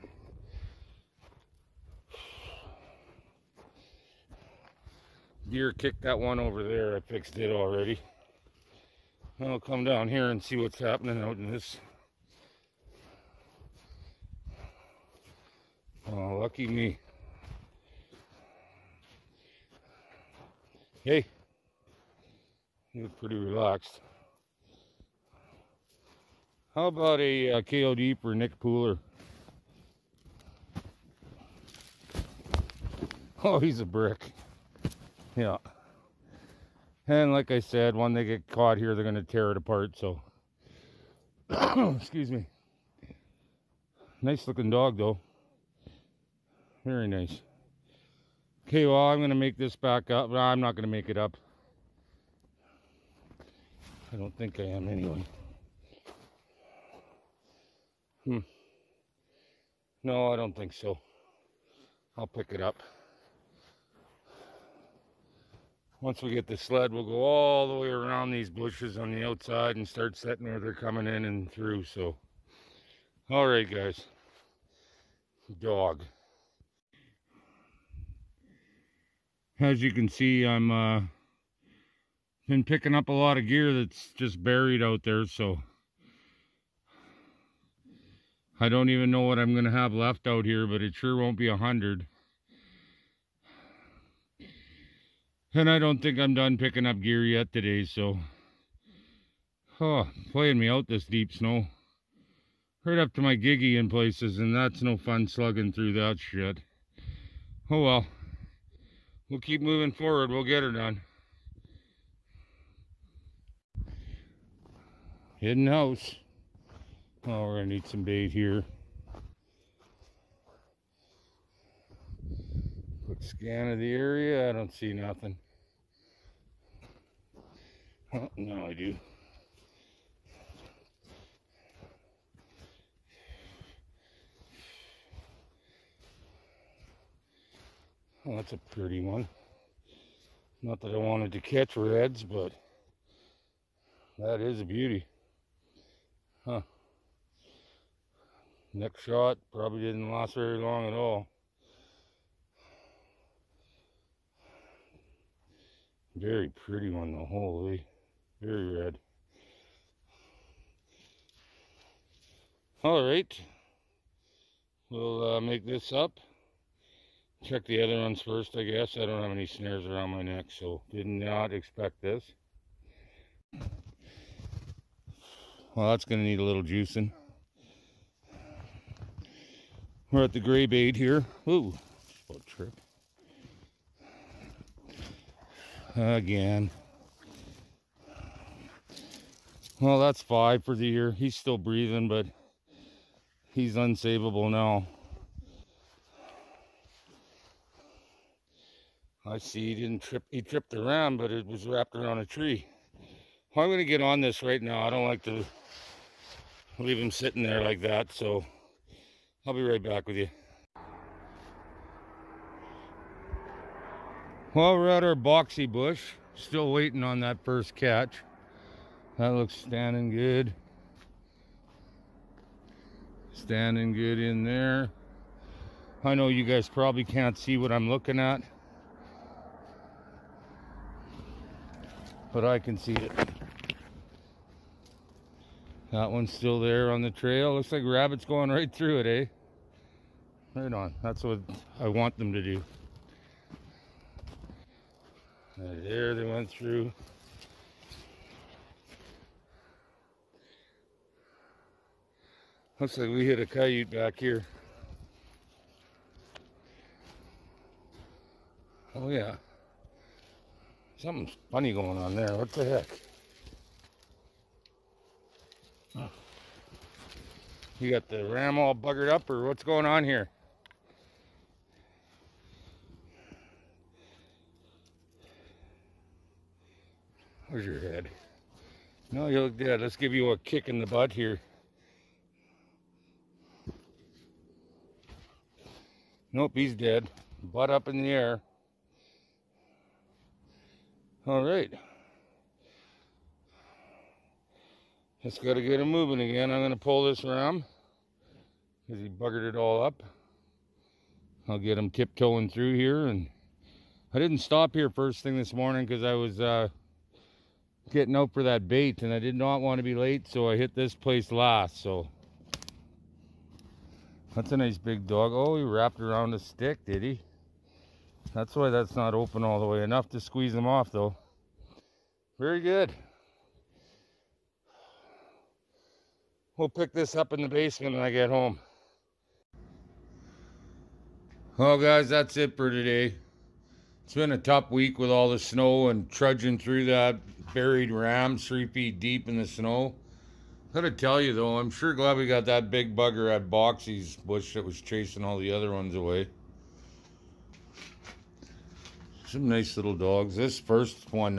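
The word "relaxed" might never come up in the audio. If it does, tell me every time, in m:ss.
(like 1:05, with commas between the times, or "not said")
0:23.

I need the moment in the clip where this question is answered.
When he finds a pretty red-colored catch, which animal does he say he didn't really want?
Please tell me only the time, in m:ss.
2:21.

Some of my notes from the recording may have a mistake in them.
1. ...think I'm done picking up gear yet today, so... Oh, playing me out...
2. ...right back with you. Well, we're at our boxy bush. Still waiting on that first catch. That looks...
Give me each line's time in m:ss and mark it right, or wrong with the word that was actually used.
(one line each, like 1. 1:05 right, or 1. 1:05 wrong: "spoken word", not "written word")
1. 1:36 right
2. 3:29 right.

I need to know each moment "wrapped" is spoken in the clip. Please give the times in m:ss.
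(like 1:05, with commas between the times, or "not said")
3:21, 5:15.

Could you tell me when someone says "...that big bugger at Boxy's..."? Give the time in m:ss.
5:42.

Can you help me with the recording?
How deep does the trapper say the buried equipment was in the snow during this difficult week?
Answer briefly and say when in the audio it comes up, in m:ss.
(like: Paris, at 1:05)
3 feet, at 5:38.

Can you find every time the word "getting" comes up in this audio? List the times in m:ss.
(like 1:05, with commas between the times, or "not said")
5:07.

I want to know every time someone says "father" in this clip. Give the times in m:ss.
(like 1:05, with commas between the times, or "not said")
not said.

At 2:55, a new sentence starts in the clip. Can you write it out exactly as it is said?
Well, that's going to need a little juicing.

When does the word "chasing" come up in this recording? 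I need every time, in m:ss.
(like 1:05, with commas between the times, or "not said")
5:44.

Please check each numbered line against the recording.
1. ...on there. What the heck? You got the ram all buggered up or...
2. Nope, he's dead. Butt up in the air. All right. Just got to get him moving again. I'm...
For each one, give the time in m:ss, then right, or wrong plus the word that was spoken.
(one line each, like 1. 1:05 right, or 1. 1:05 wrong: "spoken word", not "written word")
1. 4:21 right
2. 4:46 right.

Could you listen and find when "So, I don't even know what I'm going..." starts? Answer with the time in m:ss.
1:25.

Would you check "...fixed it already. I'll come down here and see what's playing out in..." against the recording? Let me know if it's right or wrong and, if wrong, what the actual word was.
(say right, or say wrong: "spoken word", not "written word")
wrong: "happening", not "playing".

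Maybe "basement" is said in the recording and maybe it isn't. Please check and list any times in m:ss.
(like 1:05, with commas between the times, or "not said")
5:27.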